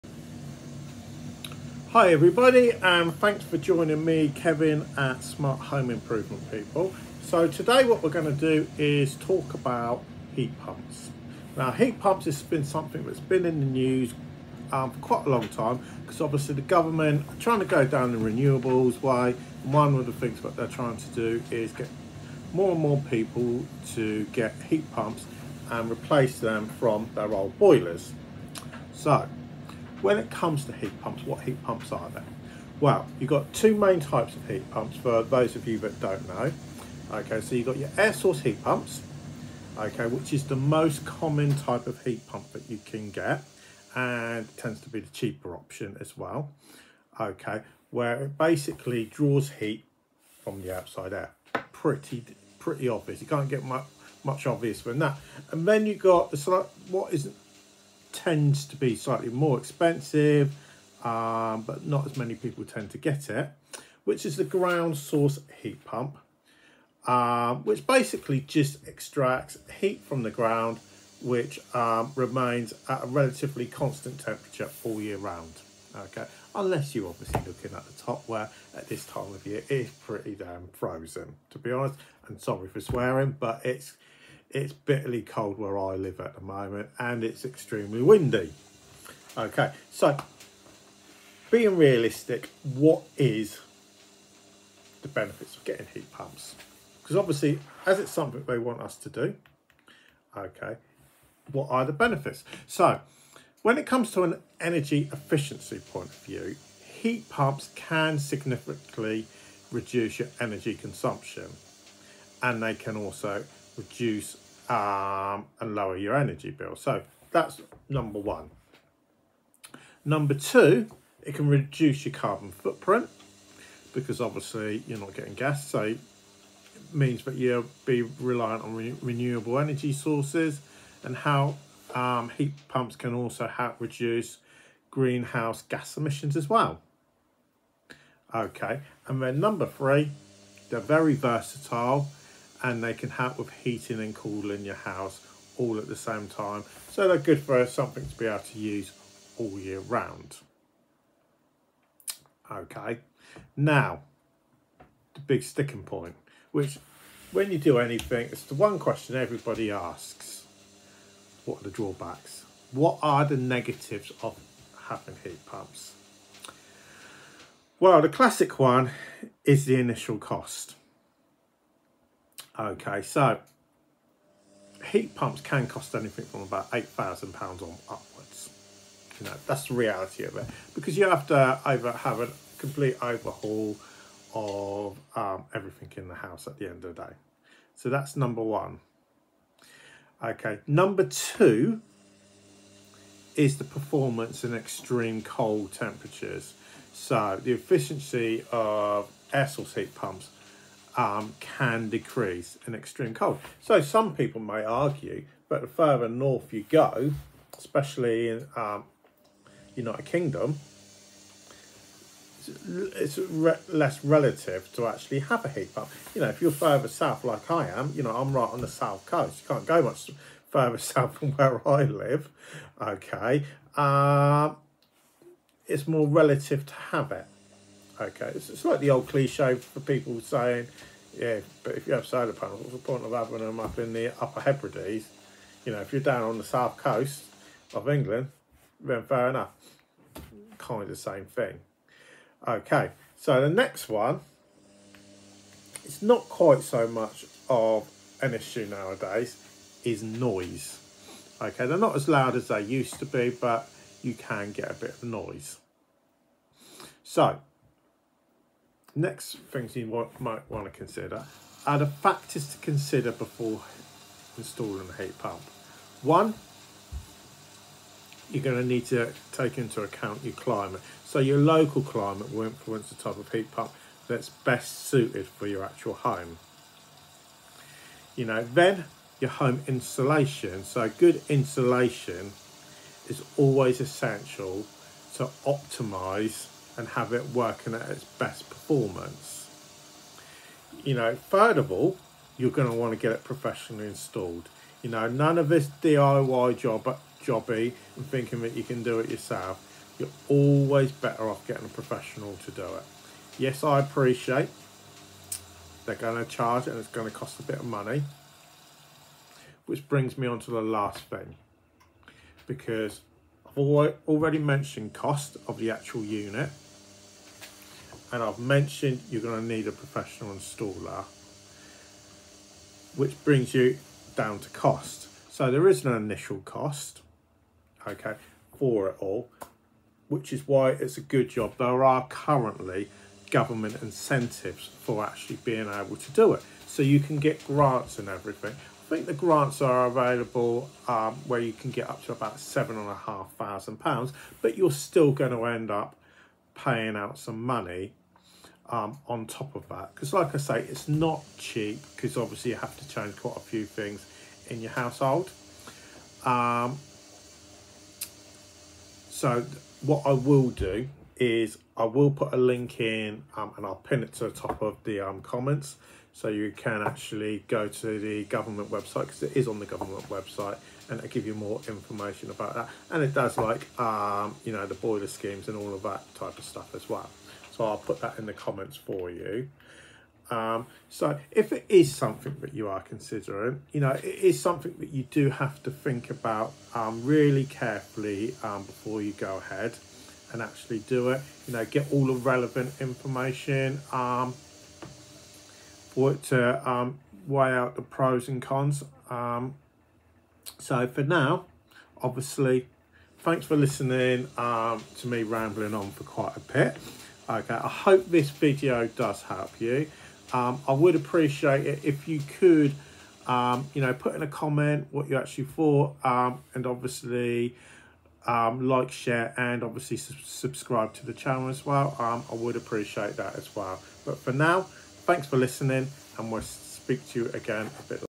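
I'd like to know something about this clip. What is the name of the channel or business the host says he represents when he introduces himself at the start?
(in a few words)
Smart Home Improvement People.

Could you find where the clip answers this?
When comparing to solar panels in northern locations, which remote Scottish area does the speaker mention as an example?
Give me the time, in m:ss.
3:54.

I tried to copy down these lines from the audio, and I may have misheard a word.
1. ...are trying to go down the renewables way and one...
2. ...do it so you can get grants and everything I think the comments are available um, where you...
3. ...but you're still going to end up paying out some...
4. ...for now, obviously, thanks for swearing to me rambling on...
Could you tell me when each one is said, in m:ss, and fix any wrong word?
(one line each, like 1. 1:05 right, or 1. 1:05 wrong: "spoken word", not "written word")
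1. 0:17 right
2. 5:36 wrong: "grants", not "comments"
3. 5:44 right
4. 6:40 wrong: "listening", not "swearing".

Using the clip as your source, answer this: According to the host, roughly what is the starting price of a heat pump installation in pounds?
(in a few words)
£8,000.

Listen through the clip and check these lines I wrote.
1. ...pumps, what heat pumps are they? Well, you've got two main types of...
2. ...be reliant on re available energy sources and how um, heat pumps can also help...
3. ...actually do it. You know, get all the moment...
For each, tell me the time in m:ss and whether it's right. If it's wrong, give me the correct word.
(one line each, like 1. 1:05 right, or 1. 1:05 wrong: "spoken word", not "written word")
1. 0:31 right
2. 2:07 wrong: "renewable", not "available"
3. 6:30 wrong: "relevant", not "moment".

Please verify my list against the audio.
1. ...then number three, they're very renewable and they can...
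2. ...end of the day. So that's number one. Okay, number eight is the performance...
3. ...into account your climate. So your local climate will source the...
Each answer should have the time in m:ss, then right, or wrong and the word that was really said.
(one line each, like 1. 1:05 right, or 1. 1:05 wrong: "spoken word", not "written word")
1. 2:19 wrong: "versatile", not "renewable"
2. 3:06 wrong: "two", not "eight"
3. 4:29 wrong: "influence", not "source".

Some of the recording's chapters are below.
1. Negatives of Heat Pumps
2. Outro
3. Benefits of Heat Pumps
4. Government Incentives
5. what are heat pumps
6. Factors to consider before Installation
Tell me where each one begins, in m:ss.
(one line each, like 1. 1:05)
1. 2:41
2. 6:41
3. 1:37
4. 5:24
5. 0:33
6. 4:22.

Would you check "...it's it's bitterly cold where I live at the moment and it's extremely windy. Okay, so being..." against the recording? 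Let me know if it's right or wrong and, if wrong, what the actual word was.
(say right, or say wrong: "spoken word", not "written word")
right.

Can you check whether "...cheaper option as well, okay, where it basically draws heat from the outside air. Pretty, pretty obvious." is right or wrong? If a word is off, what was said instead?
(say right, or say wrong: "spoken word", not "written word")
right.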